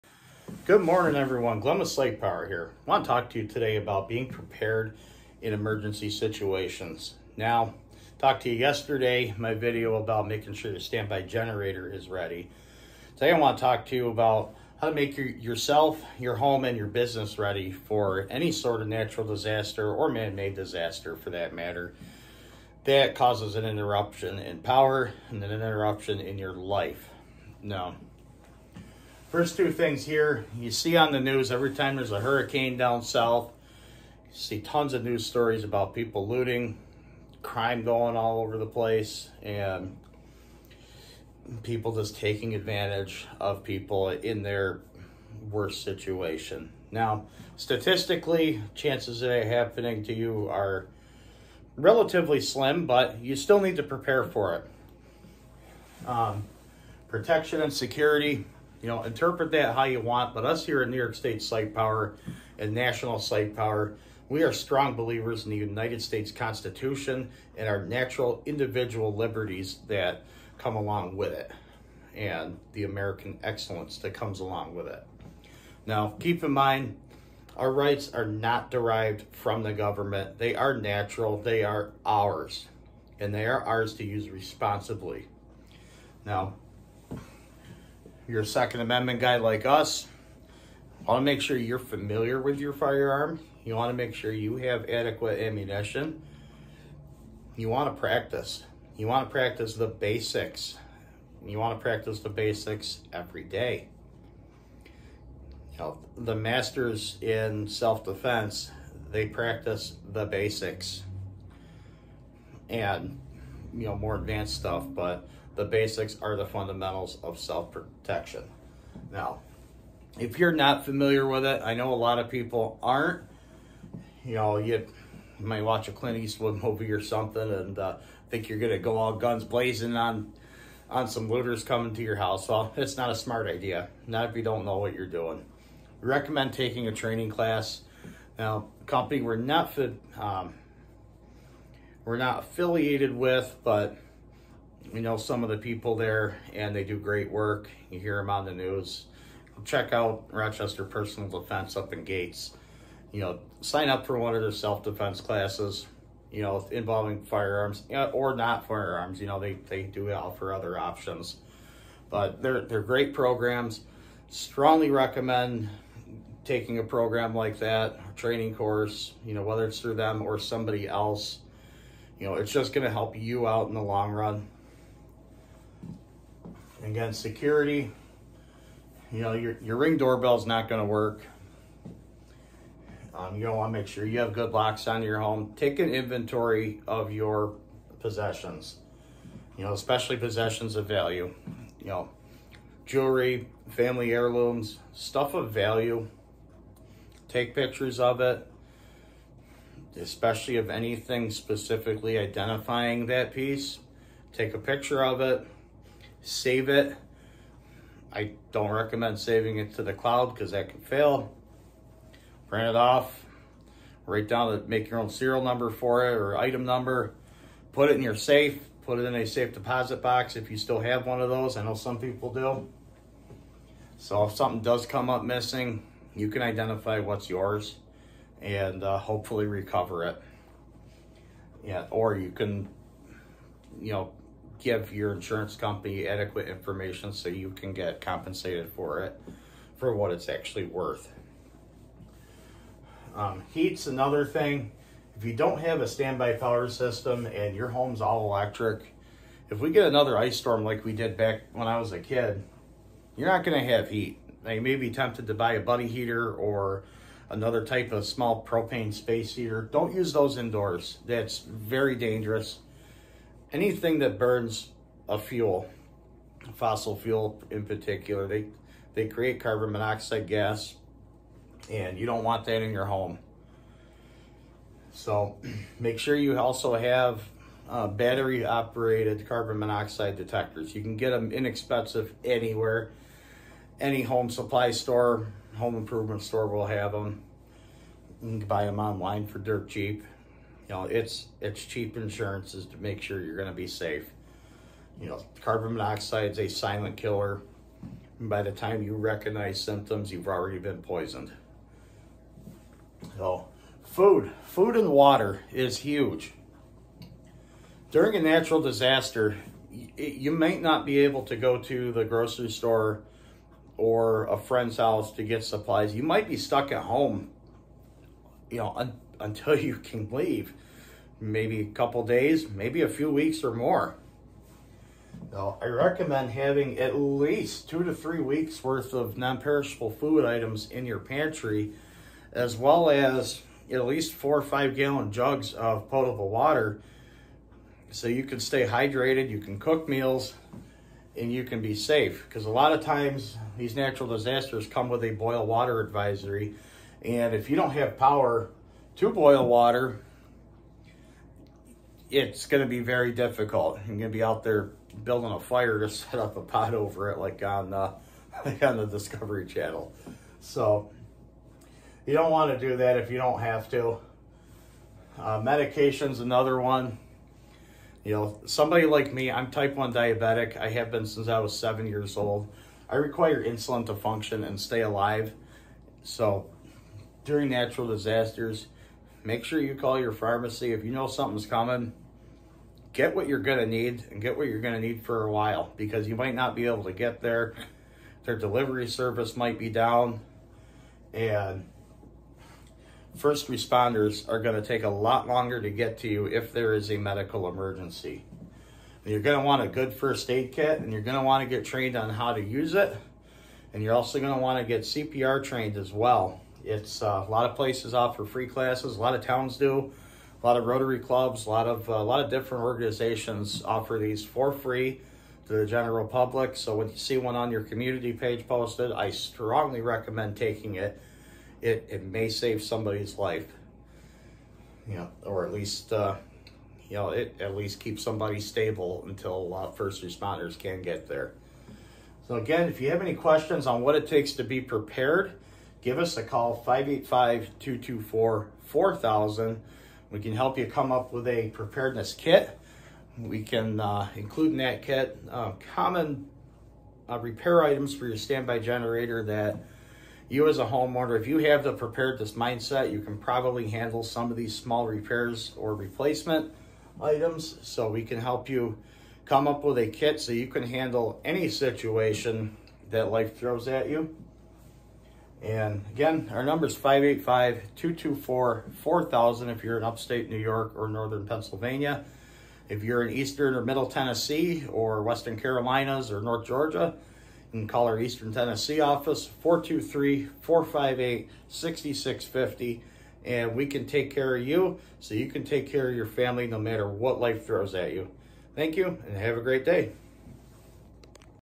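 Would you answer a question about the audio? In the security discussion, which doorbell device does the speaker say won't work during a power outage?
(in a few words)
Ring doorbell.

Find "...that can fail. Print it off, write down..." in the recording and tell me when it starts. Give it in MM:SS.
03:30.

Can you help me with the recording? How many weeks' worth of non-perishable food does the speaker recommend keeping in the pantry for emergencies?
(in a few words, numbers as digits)
2 to 3 weeks.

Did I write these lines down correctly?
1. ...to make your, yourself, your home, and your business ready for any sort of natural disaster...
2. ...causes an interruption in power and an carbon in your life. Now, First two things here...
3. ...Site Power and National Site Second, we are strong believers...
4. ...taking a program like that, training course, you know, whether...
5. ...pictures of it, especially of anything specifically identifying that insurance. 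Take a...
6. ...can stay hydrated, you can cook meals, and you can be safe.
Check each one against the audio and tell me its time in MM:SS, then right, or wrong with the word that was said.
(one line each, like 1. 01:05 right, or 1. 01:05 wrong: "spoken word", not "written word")
1. 00:14 right
2. 00:23 wrong: "interruption", not "carbon"
3. 01:01 wrong: "Power", not "Second"
4. 02:46 right
5. 03:17 wrong: "piece", not "insurance"
6. 05:38 right.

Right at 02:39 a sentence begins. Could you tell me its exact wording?
You know, they, they do offer other options.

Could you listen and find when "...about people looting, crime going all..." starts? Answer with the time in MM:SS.
00:35.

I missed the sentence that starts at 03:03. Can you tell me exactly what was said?
Um, you want to make sure you have good locks on your home.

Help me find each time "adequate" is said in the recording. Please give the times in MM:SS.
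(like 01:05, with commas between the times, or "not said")
01:34, 03:56.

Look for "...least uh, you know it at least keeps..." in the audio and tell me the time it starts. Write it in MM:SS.
07:05.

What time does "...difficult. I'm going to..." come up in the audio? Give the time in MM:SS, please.
05:53.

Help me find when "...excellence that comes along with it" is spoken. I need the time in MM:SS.
01:13.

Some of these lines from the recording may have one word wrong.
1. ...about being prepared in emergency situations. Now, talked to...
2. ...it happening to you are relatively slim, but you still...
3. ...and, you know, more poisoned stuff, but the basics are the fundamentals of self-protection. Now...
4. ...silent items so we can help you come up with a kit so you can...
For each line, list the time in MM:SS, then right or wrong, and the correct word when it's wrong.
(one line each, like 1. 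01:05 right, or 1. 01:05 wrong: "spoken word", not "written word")
1. 00:03 right
2. 00:49 right
3. 01:52 wrong: "advanced", not "poisoned"
4. 07:35 wrong: "replacement", not "silent".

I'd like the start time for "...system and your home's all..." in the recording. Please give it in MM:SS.
04:06.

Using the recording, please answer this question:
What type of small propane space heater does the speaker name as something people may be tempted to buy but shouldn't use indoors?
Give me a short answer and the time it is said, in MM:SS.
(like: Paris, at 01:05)
Buddy heater, at 04:15.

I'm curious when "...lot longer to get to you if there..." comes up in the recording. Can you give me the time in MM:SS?
06:34.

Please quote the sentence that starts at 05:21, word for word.
Maybe a couple days, maybe a few weeks or more.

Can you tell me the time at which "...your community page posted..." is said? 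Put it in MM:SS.
06:57.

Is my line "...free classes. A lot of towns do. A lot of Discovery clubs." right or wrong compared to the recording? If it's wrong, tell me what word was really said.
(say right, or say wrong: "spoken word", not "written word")
wrong: "Rotary", not "Discovery".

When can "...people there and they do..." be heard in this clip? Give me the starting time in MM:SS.
02:25.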